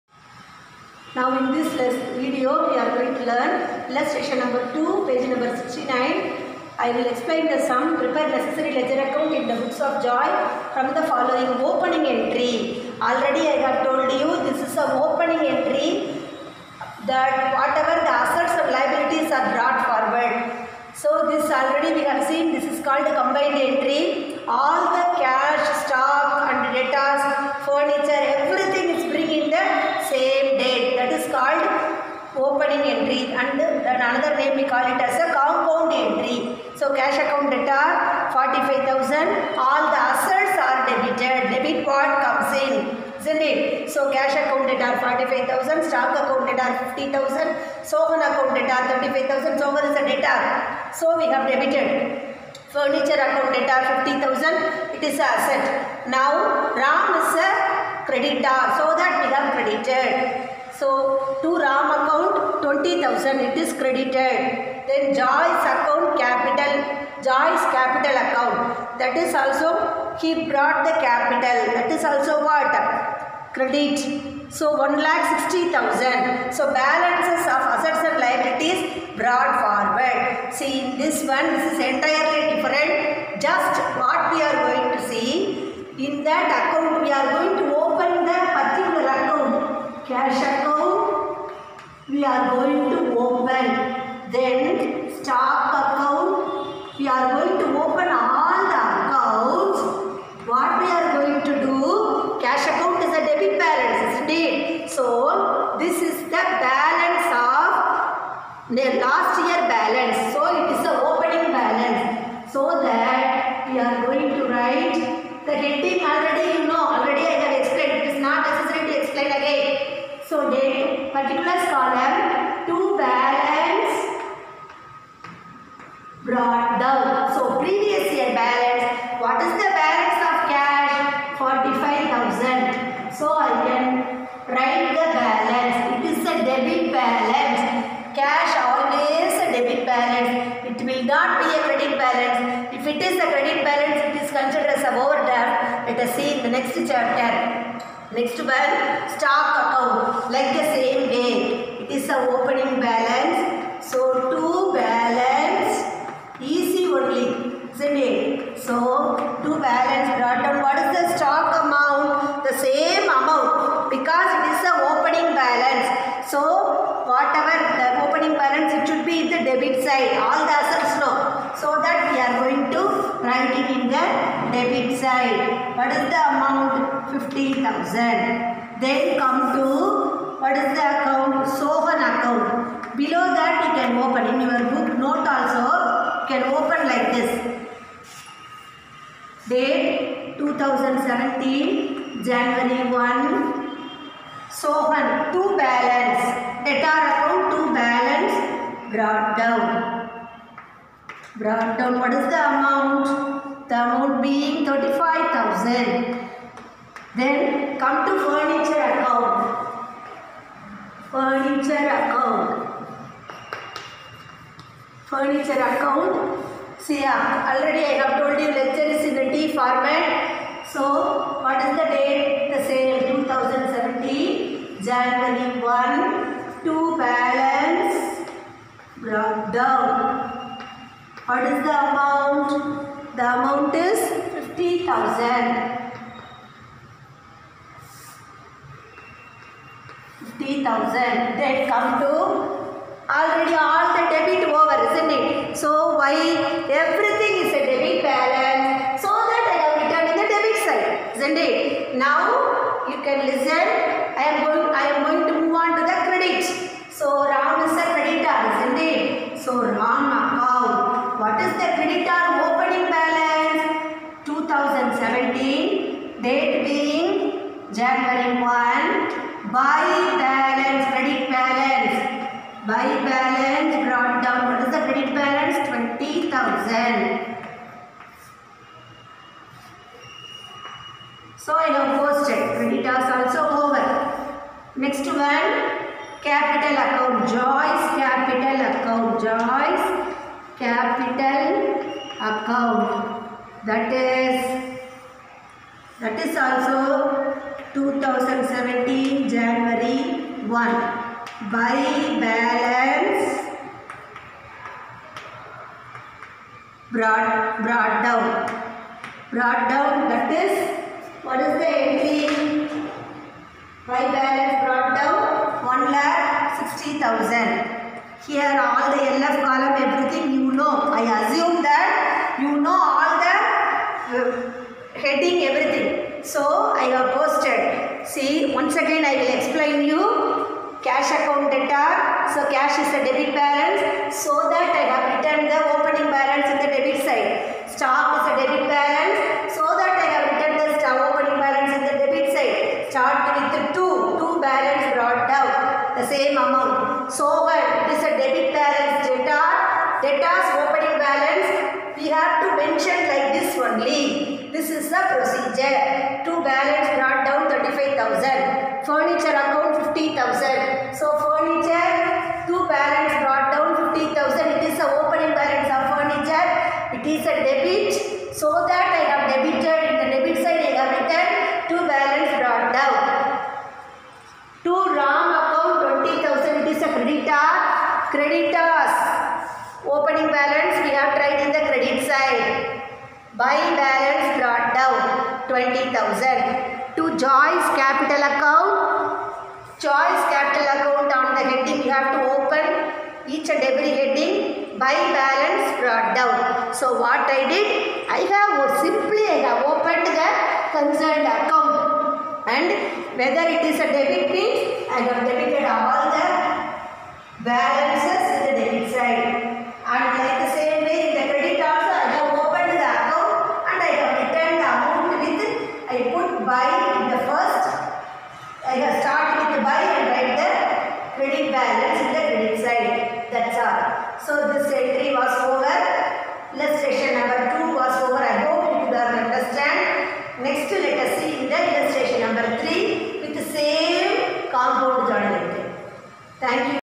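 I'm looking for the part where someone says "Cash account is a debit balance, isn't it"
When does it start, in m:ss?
1:42.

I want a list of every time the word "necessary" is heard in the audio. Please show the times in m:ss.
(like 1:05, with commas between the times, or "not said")
0:08, 1:58.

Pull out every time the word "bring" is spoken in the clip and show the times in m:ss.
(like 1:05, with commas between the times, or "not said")
0:29.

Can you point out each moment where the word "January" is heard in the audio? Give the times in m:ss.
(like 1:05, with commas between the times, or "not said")
3:12, 3:44, 4:27, 4:59.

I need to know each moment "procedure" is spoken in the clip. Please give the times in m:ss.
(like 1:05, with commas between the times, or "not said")
5:55.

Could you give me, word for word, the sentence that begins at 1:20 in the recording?
See in this one this is entirely different.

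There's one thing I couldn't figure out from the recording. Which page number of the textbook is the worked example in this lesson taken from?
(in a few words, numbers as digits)
69.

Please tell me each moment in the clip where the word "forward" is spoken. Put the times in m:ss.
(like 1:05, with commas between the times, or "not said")
0:19, 1:19.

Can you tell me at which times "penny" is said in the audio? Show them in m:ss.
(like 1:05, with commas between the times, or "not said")
not said.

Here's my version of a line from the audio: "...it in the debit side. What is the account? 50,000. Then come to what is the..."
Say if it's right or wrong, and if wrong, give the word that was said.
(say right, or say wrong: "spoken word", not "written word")
wrong: "amount", not "account".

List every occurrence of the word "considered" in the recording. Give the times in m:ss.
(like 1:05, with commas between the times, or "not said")
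2:24.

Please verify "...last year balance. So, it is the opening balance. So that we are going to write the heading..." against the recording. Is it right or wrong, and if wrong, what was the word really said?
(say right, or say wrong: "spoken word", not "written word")
right.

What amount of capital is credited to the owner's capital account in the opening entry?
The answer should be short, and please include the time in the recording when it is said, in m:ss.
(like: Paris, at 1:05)
1,60,000, at 1:14.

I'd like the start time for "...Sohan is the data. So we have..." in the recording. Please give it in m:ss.
0:49.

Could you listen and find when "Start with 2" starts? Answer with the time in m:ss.
5:42.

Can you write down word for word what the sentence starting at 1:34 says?
Then stock account, we are going to open all the accounts.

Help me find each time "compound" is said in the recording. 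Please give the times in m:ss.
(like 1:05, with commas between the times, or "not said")
0:35, 7:14.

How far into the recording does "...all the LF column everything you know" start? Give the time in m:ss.
5:18.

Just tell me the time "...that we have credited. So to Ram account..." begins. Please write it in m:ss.
0:58.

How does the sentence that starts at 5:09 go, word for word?
Brought down that is what is the entry?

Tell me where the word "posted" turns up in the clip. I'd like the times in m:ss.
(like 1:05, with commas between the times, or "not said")
4:42, 5:27.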